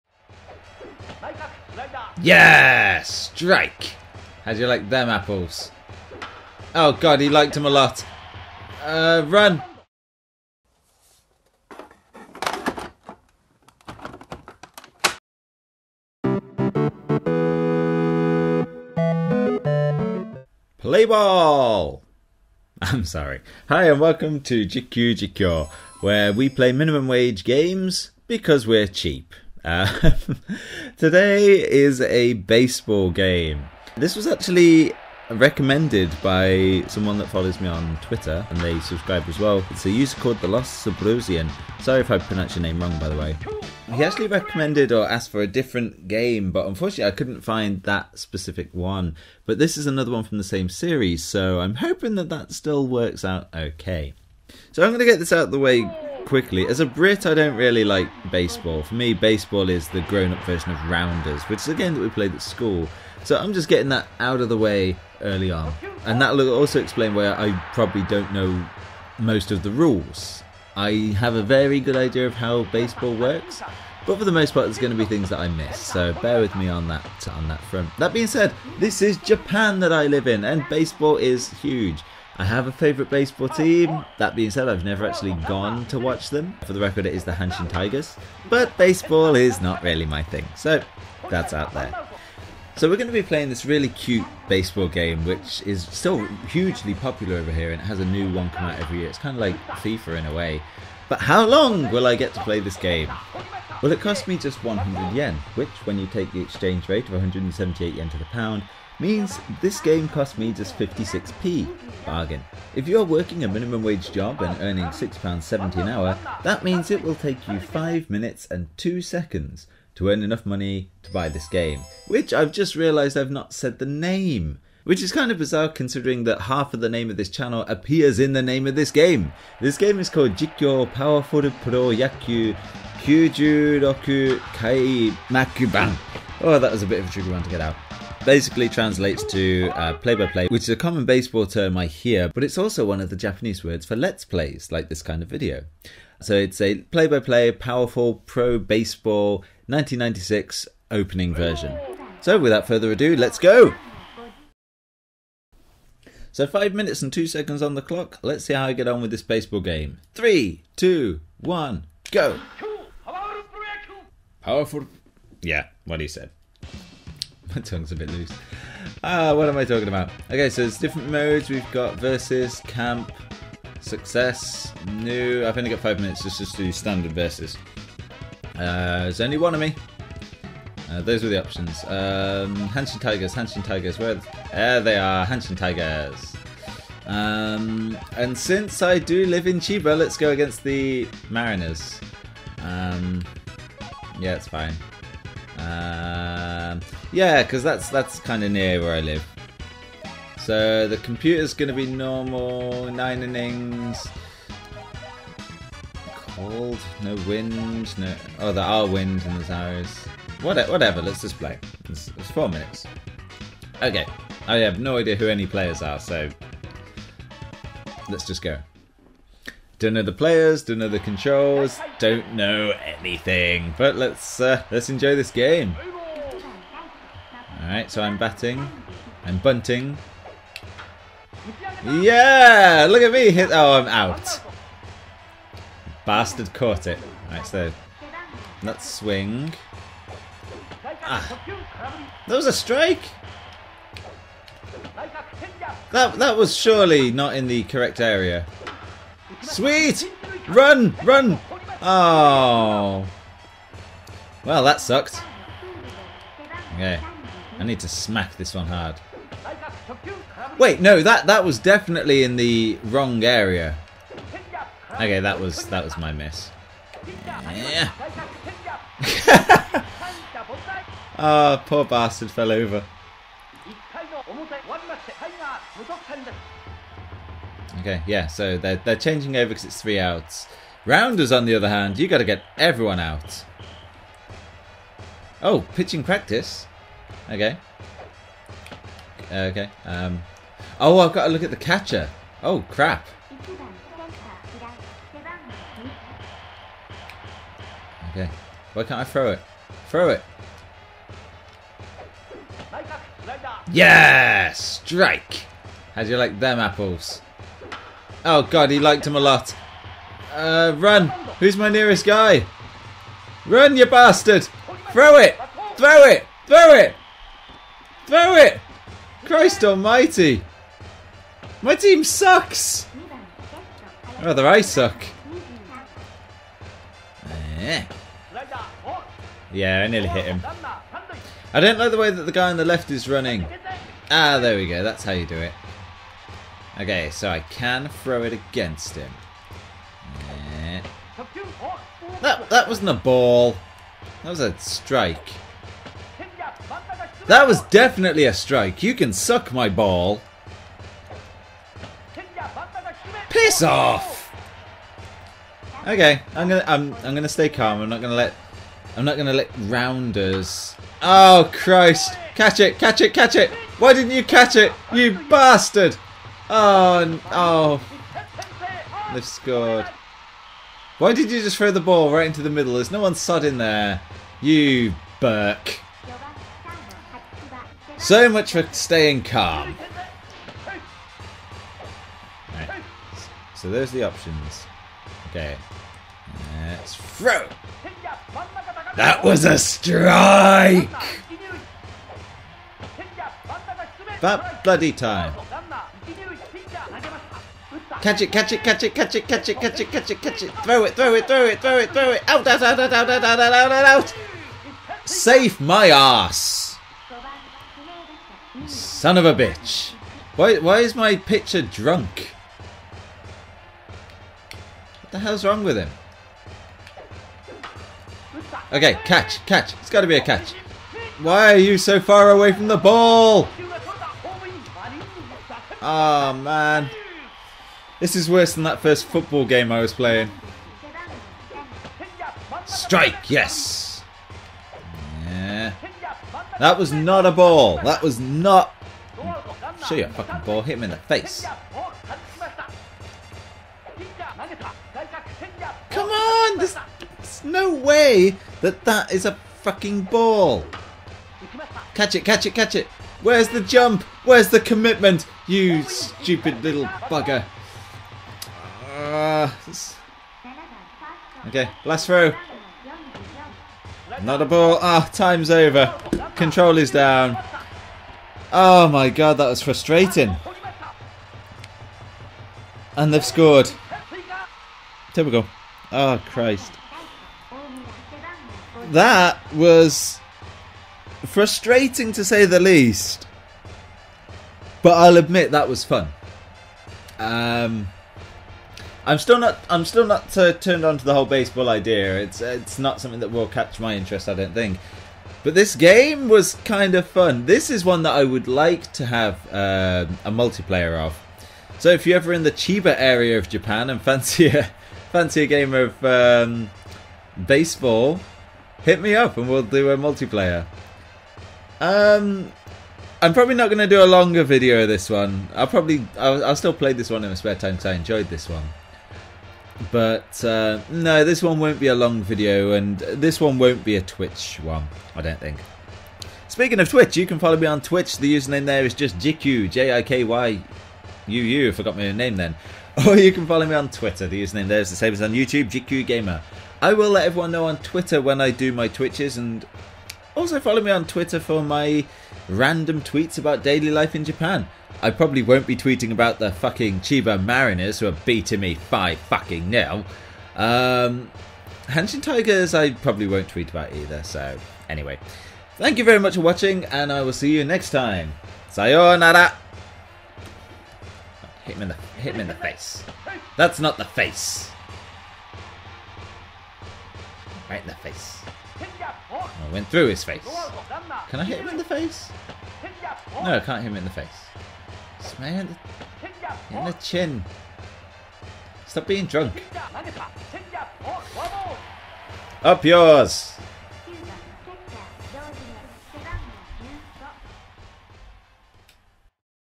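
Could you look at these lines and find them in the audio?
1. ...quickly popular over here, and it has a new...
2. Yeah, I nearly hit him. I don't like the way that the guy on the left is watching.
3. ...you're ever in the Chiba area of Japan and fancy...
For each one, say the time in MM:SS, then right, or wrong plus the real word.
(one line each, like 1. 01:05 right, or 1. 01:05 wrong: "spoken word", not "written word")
1. 01:36 wrong: "hugely", not "quickly"
2. 05:29 wrong: "running", not "watching"
3. 08:22 right.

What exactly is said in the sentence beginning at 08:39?
But uh, no, this one won't be a long video, and this one won't be a Twitch one, I don't think.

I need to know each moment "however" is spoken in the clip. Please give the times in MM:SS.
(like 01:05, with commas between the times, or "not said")
not said.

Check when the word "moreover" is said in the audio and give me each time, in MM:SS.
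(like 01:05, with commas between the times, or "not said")
not said.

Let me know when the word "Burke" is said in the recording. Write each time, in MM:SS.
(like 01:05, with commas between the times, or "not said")
06:15.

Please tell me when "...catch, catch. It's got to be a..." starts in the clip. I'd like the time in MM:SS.
06:59.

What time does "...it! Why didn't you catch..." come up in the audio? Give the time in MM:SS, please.
06:03.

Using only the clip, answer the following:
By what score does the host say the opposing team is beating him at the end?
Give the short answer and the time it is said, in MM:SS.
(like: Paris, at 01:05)
5 nil, at 09:08.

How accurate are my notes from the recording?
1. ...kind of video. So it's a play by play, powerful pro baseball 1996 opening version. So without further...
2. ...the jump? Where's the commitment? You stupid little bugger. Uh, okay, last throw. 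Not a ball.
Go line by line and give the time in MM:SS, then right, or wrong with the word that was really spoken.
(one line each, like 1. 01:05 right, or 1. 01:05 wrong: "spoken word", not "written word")
1. 02:25 right
2. 07:33 right.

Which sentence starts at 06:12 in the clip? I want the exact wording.
There's no one sod in there.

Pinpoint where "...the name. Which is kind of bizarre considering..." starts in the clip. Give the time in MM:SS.
02:03.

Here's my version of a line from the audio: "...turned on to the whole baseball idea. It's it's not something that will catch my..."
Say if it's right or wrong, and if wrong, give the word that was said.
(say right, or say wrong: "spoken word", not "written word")
right.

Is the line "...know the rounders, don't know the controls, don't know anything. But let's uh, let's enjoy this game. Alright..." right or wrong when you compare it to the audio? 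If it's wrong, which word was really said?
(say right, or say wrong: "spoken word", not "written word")
wrong: "players", not "rounders".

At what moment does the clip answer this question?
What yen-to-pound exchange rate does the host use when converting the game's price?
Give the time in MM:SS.
01:47.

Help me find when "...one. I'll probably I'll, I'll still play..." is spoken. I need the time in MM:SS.
08:35.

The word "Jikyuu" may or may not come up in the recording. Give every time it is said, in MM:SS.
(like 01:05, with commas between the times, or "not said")
00:24, 08:49, 08:55.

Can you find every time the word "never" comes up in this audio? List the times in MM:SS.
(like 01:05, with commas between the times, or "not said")
01:24.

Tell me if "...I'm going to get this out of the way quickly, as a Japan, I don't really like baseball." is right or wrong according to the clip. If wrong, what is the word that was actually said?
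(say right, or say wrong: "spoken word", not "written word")
wrong: "Brit", not "Japan".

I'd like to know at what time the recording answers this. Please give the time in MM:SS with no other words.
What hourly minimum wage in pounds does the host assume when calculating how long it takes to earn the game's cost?
01:54.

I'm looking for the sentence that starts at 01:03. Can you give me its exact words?
So I'm just getting that out of the way early on.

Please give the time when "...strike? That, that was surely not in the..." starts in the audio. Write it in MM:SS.
04:02.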